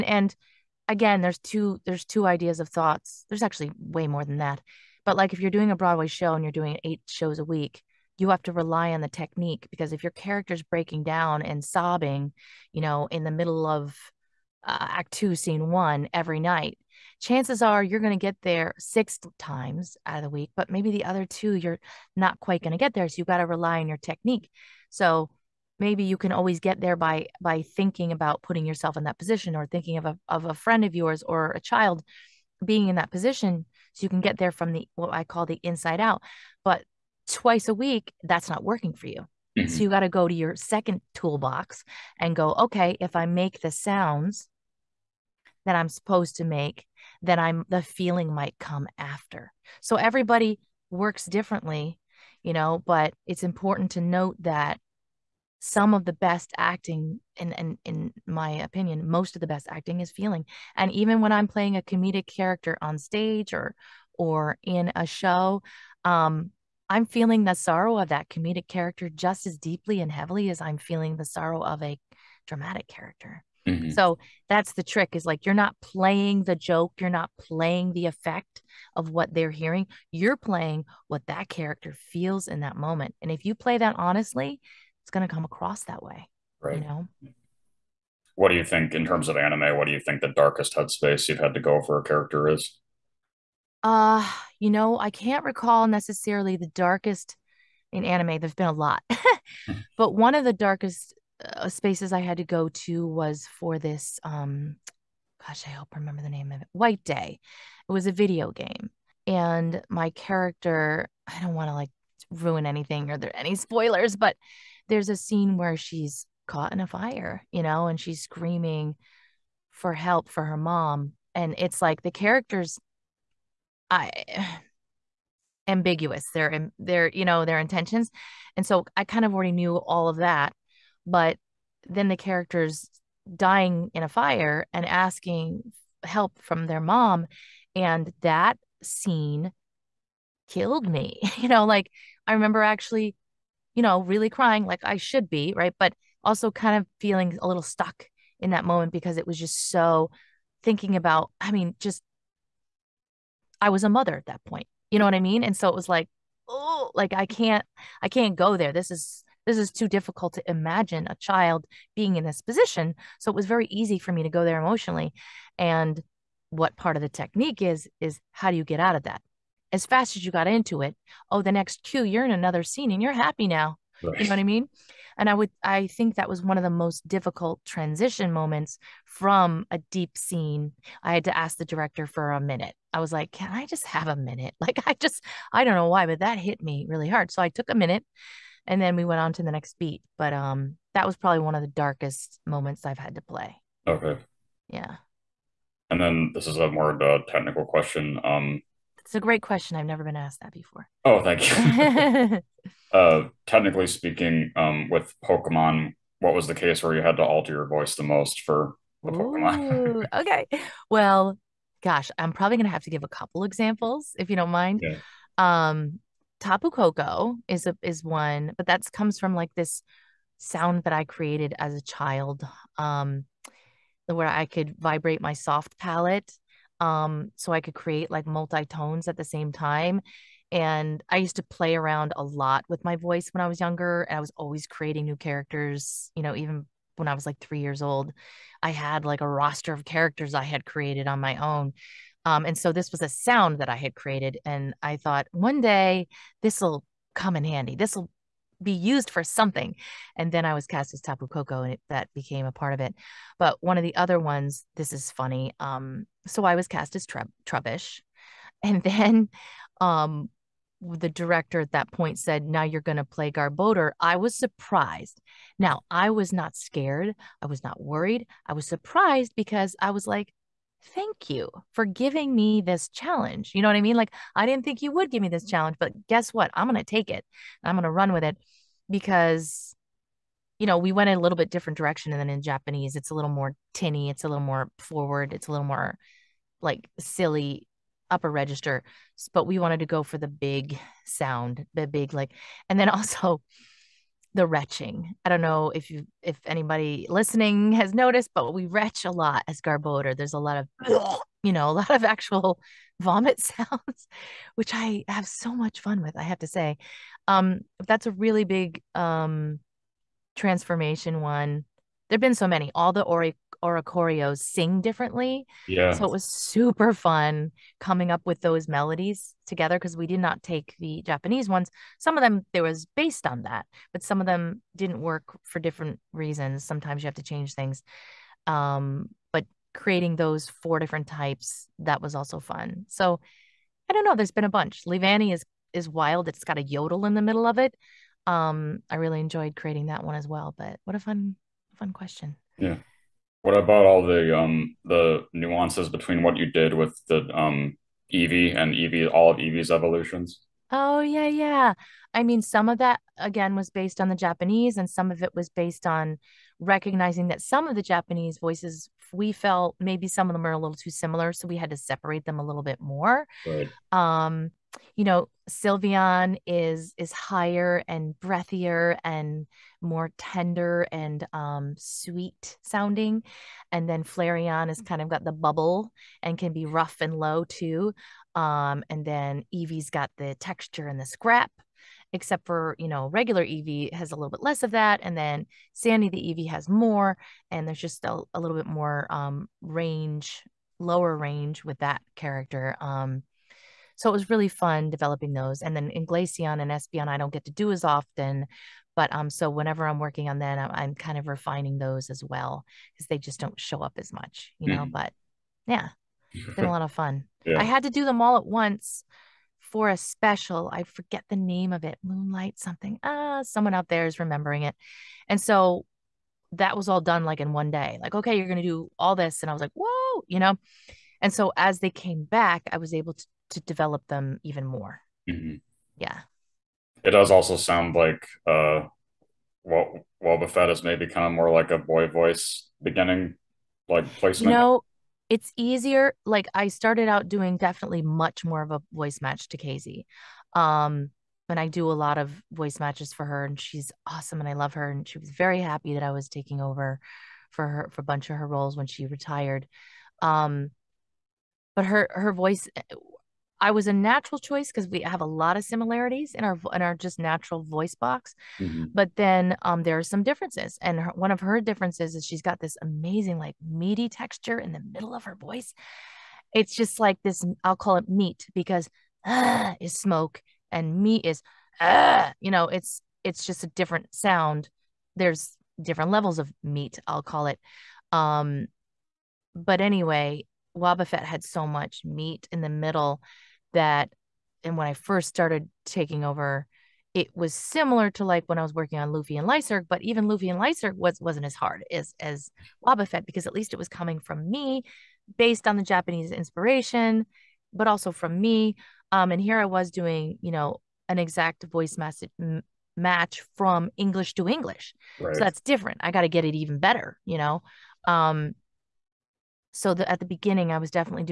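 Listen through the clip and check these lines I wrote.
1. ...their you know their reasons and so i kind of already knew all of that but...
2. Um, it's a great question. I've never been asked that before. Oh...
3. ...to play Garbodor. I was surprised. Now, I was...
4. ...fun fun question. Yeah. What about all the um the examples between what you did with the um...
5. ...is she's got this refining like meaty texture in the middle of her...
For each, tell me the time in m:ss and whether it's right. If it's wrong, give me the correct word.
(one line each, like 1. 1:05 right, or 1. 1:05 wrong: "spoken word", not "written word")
1. 2:06 wrong: "intentions", not "reasons"
2. 3:18 right
3. 4:22 right
4. 5:40 wrong: "nuances", not "examples"
5. 7:42 wrong: "amazing", not "refining".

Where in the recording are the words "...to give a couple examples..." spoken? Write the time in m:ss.
3:32.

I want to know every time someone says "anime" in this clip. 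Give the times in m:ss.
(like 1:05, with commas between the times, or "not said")
1:29, 1:38.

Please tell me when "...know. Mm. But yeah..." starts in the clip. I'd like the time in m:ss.
6:44.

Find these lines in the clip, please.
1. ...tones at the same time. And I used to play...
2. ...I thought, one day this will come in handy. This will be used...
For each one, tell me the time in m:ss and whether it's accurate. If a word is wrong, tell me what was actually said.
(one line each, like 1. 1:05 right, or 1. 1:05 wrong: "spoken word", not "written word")
1. 3:48 right
2. 4:04 right.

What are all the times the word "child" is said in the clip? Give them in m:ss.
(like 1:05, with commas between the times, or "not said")
0:31, 2:41, 3:41.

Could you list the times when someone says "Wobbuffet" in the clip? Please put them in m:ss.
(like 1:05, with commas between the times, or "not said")
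7:10, 8:00, 8:12.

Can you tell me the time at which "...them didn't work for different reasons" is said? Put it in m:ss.
5:24.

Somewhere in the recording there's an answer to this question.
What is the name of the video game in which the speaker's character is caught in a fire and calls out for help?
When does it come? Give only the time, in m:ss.
1:46.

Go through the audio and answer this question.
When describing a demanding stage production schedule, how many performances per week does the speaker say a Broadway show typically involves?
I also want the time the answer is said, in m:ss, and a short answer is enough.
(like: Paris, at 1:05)
8, at 0:06.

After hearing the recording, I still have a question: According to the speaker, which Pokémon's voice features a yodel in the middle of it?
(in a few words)
Levani.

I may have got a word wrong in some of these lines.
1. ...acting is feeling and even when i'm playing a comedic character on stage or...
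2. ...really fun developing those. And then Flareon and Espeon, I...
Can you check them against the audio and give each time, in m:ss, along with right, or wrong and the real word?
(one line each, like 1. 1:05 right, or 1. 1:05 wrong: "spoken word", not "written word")
1. 0:59 right
2. 6:34 wrong: "Inglacion", not "Flareon".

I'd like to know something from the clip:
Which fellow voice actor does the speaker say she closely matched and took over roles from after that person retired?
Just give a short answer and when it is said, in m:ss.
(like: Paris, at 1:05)
Kayzie, at 7:19.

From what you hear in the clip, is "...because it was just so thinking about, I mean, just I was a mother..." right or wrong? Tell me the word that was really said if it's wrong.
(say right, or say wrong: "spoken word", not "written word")
right.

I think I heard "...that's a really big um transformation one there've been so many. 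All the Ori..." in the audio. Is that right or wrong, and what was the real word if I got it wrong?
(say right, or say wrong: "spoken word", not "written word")
right.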